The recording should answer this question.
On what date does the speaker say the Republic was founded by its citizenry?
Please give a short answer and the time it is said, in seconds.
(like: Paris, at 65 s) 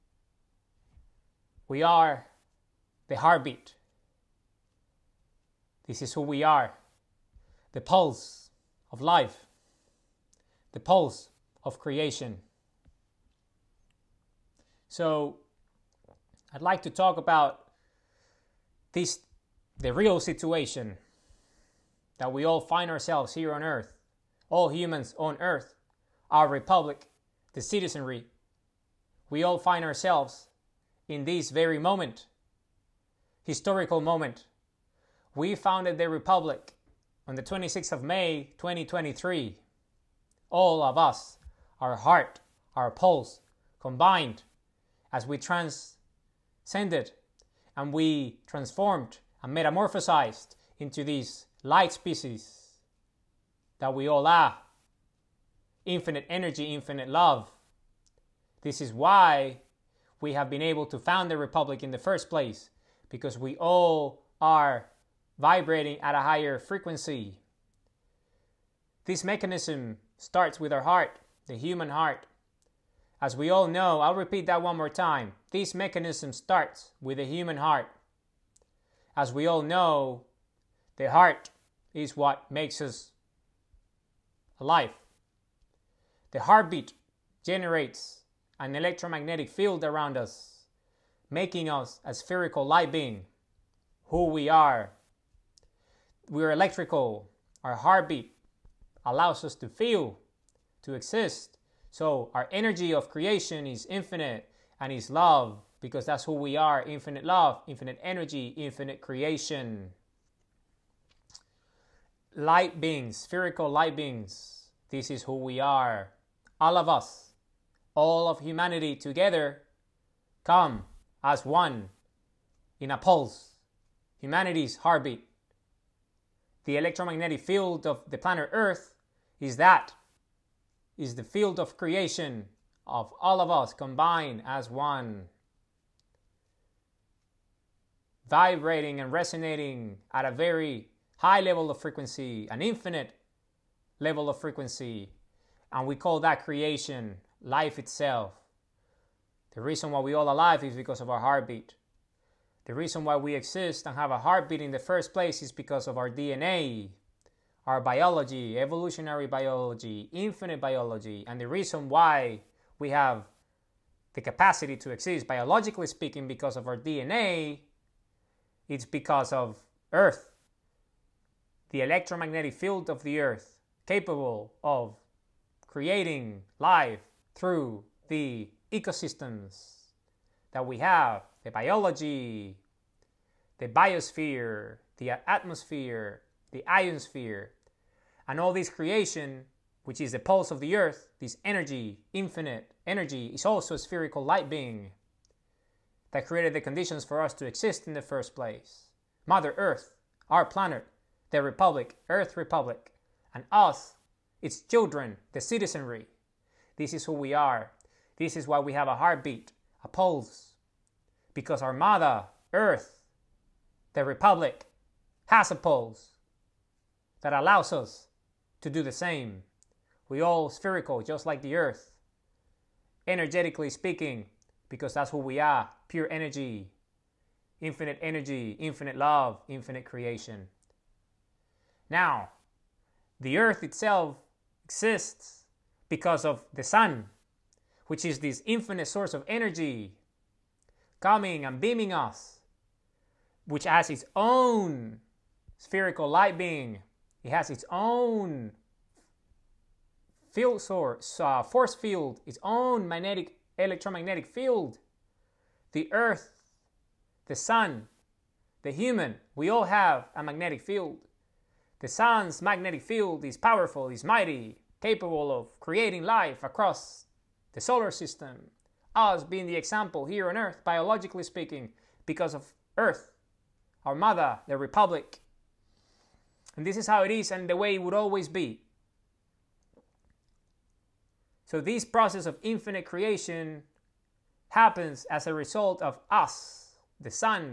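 26 May 2023, at 37 s.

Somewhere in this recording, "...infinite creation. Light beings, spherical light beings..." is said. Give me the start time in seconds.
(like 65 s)
108 s.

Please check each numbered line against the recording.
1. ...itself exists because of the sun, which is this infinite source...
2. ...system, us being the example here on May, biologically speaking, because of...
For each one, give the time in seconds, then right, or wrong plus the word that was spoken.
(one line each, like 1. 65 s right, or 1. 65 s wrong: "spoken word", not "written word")
1. 233 s right
2. 267 s wrong: "Earth", not "May".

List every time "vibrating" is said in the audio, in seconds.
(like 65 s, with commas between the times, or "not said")
65 s, 138 s.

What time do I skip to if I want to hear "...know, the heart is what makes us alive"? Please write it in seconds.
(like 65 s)
79 s.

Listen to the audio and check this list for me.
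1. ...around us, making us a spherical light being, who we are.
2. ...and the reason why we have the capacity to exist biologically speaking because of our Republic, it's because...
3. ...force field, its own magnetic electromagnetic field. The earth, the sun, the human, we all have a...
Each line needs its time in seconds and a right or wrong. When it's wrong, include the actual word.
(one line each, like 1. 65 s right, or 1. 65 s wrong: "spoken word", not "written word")
1. 89 s right
2. 161 s wrong: "DNA", not "Republic"
3. 251 s right.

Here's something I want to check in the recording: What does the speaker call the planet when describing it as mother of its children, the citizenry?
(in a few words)
Earth Republic.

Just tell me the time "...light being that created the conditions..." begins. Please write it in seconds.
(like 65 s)
194 s.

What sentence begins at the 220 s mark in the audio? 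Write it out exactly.
We all spherical, just like the Earth.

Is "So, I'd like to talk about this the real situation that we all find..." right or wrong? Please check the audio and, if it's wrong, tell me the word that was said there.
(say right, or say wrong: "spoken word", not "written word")
right.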